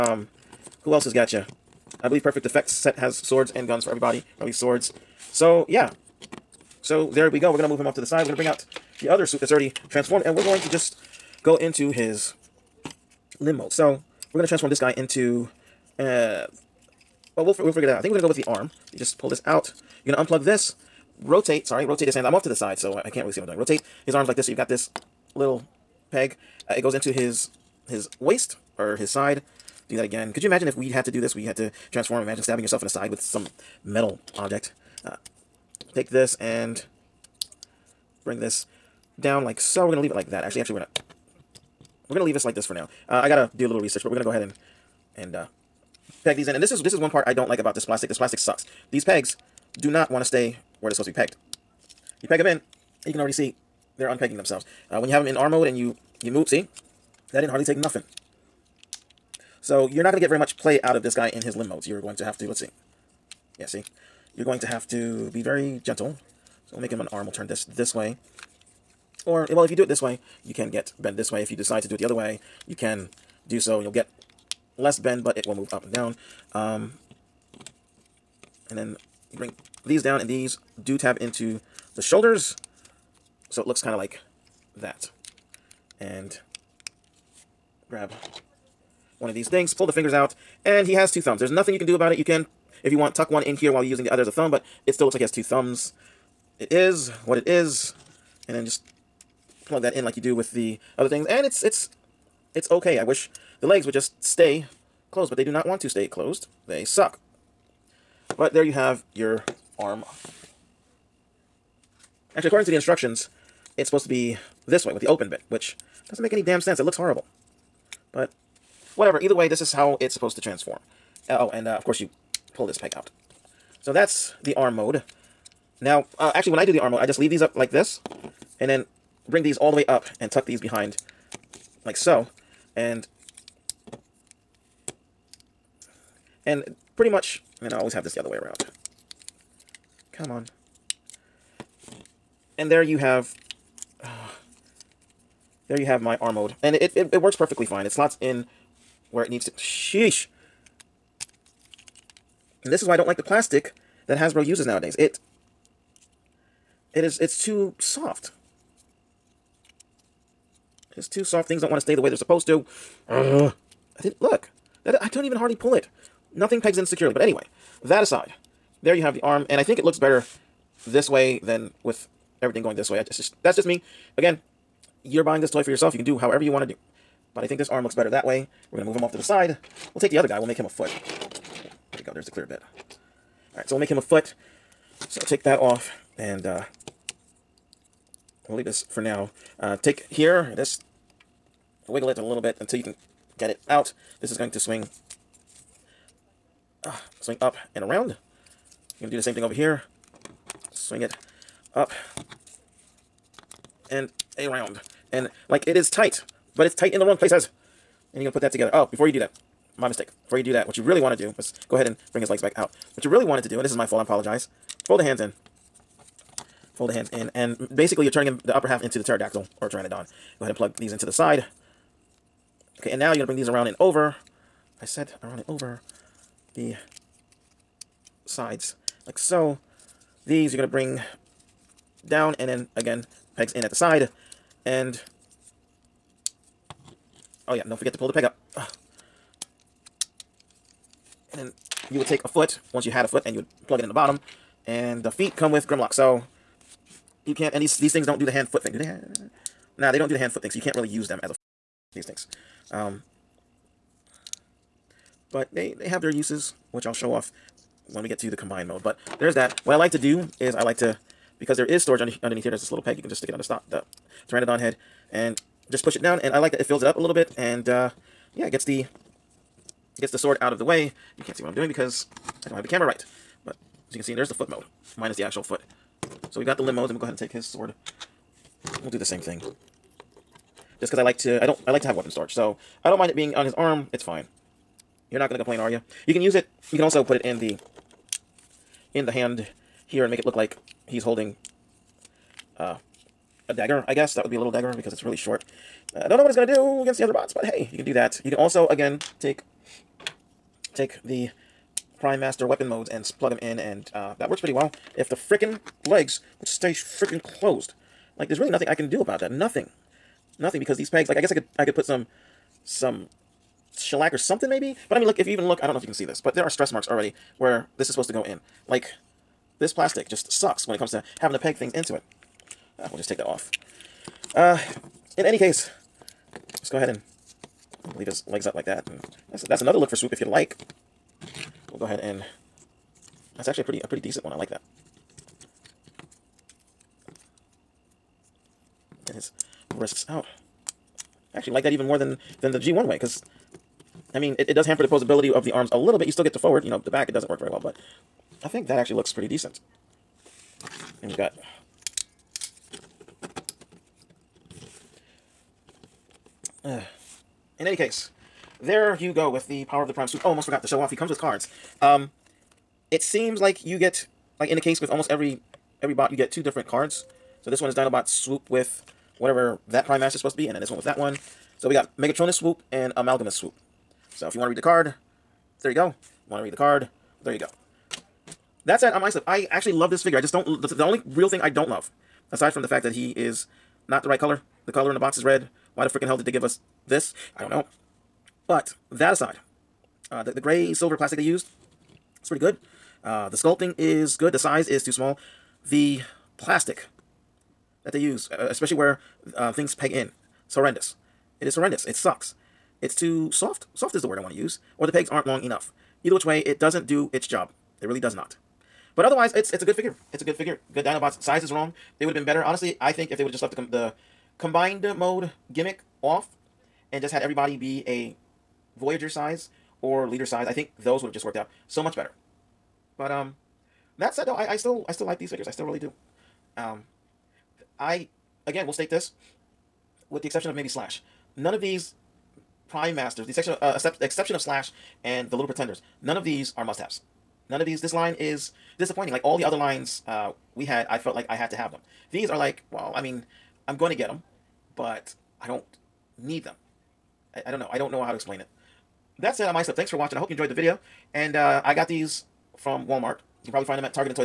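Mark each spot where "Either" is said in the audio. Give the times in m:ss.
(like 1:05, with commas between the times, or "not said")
1:59, 6:46.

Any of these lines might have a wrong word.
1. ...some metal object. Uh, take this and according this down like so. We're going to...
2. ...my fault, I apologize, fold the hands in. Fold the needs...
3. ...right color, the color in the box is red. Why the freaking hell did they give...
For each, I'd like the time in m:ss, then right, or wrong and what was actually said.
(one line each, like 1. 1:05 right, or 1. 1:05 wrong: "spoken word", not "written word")
1. 0:33 wrong: "bring", not "according"
2. 3:33 wrong: "hands", not "needs"
3. 6:24 right.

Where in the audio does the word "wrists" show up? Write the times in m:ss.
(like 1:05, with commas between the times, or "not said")
5:39.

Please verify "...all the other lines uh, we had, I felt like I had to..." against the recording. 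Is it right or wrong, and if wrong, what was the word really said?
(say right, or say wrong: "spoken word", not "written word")
right.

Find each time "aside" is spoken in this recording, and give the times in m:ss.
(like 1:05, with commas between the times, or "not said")
2:48, 6:22, 6:29.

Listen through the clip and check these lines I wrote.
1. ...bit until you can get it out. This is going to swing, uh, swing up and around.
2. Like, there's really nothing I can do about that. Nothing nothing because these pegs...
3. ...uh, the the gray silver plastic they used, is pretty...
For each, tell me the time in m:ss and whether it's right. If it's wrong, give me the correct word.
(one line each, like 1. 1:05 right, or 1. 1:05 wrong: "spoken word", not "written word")
1. 3:12 right
2. 5:08 right
3. 6:30 right.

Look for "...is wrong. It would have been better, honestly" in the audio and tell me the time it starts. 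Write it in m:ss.
6:51.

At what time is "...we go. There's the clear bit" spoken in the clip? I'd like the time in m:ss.
3:01.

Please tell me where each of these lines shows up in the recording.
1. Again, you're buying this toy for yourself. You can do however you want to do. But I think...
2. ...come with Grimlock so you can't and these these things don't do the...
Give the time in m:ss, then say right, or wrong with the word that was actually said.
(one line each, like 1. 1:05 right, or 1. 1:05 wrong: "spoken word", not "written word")
1. 2:54 right
2. 4:05 right.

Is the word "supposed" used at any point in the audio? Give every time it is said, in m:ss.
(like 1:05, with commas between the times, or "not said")
0:50, 1:53, 2:00, 2:42, 5:17, 6:10.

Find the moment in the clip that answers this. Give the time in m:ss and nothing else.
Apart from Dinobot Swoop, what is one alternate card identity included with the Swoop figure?
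6:11.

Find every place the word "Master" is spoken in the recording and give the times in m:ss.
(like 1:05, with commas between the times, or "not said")
5:02, 6:10, 7:12.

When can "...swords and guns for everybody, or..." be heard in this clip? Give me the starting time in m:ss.
0:03.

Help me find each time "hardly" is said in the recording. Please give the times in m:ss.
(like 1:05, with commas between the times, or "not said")
0:57, 2:45.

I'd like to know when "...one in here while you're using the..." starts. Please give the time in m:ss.
1:33.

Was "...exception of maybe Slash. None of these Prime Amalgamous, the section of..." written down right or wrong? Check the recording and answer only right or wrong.
wrong.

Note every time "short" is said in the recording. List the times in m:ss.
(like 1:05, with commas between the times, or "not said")
4:55.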